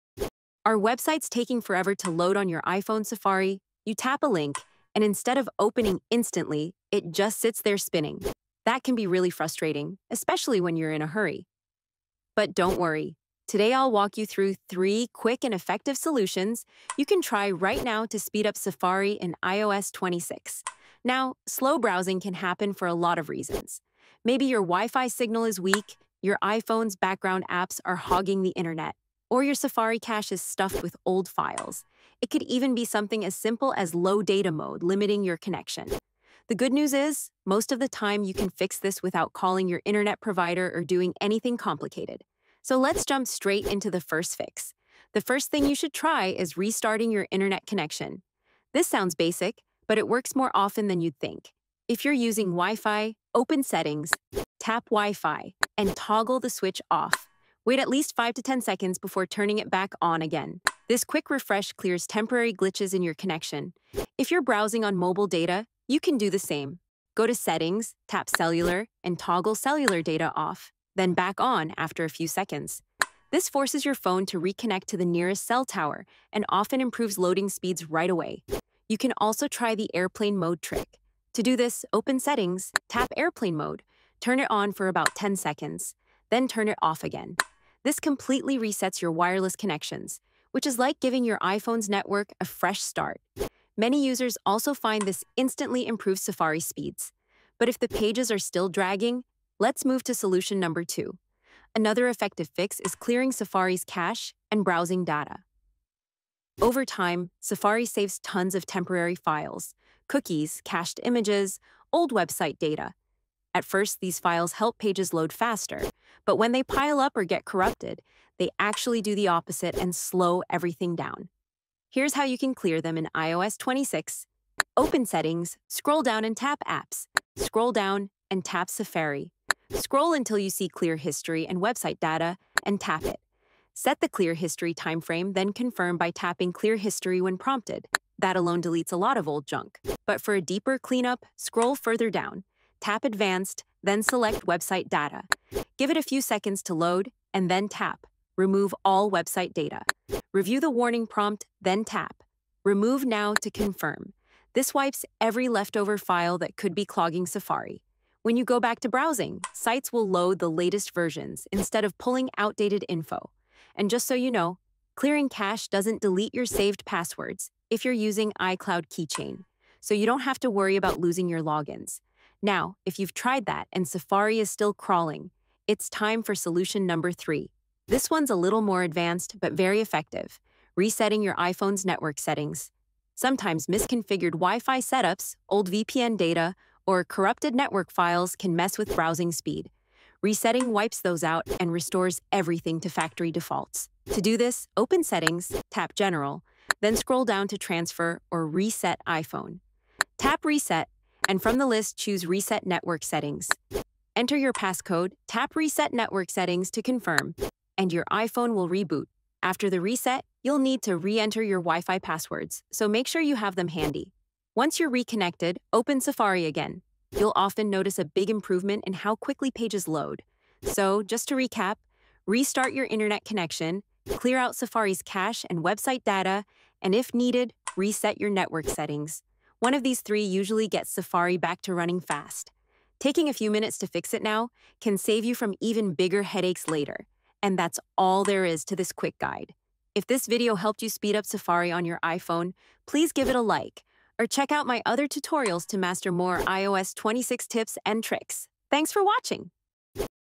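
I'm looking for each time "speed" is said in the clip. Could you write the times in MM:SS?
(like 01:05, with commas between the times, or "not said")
00:18, 01:17, 01:36, 03:09, 04:00.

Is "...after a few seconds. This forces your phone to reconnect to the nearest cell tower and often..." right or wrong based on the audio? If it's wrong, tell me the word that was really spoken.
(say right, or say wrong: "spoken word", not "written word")
right.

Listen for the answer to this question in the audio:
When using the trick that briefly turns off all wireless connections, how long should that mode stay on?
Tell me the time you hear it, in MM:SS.
01:24.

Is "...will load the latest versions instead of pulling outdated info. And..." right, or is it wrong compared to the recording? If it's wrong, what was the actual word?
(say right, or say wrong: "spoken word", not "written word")
right.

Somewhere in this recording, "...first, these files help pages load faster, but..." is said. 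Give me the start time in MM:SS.
01:53.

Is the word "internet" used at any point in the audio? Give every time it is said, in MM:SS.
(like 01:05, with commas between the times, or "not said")
00:28, 00:39, 00:47, 03:42.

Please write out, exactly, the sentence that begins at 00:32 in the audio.
It could even be something as simple as low data mode, limiting your connection.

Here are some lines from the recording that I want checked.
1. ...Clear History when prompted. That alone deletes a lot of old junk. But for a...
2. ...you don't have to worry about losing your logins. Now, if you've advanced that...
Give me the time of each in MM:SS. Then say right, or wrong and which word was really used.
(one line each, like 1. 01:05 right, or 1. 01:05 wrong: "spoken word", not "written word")
1. 02:16 right
2. 02:49 wrong: "tried", not "advanced".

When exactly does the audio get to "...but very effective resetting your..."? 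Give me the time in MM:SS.
02:59.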